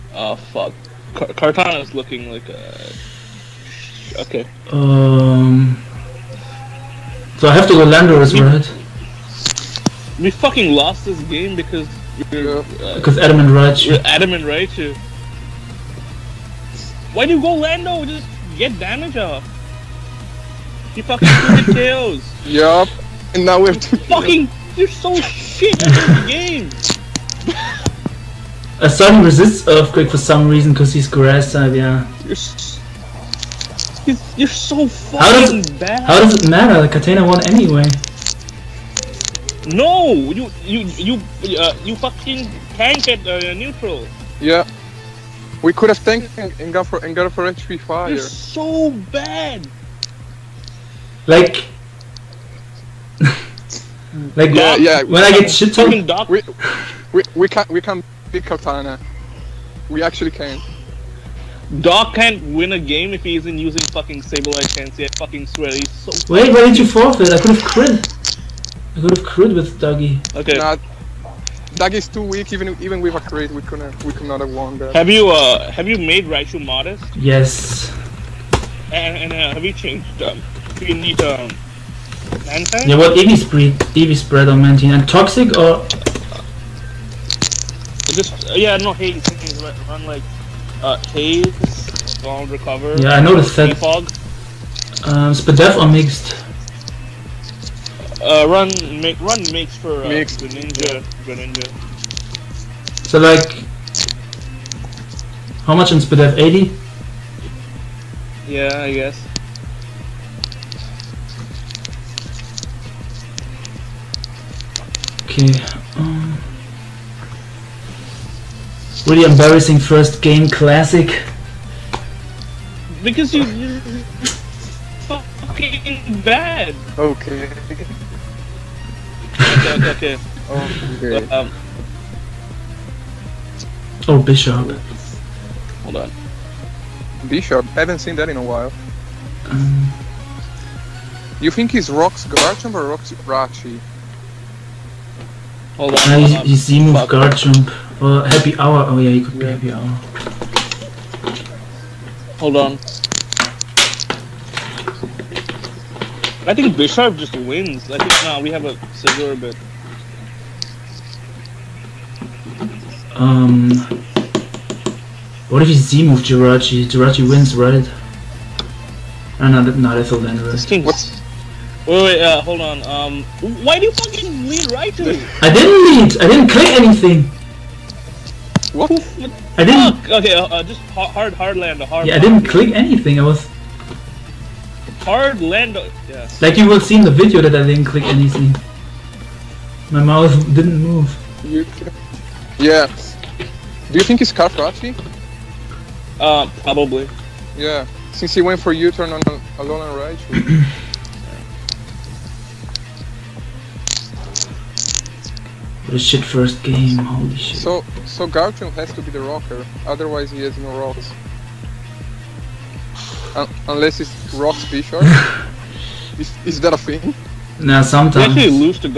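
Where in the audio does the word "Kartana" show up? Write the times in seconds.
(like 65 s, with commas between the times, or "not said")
1 s, 36 s, 58 s.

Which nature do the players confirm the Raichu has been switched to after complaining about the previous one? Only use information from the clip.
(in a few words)
Modest.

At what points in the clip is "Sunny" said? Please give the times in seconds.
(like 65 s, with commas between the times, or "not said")
28 s.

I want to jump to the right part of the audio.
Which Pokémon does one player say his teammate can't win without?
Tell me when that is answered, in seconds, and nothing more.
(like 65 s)
64 s.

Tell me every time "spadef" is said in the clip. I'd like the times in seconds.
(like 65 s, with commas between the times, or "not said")
95 s, 105 s.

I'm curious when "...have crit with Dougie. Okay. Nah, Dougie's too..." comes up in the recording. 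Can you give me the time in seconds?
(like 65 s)
69 s.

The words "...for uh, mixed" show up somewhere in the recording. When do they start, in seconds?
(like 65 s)
99 s.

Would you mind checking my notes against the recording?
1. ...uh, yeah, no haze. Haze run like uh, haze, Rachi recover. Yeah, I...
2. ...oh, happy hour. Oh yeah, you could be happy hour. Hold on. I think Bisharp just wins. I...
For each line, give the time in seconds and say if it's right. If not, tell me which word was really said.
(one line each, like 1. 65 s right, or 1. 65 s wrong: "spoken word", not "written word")
1. 88 s wrong: "Long", not "Rachi"
2. 148 s right.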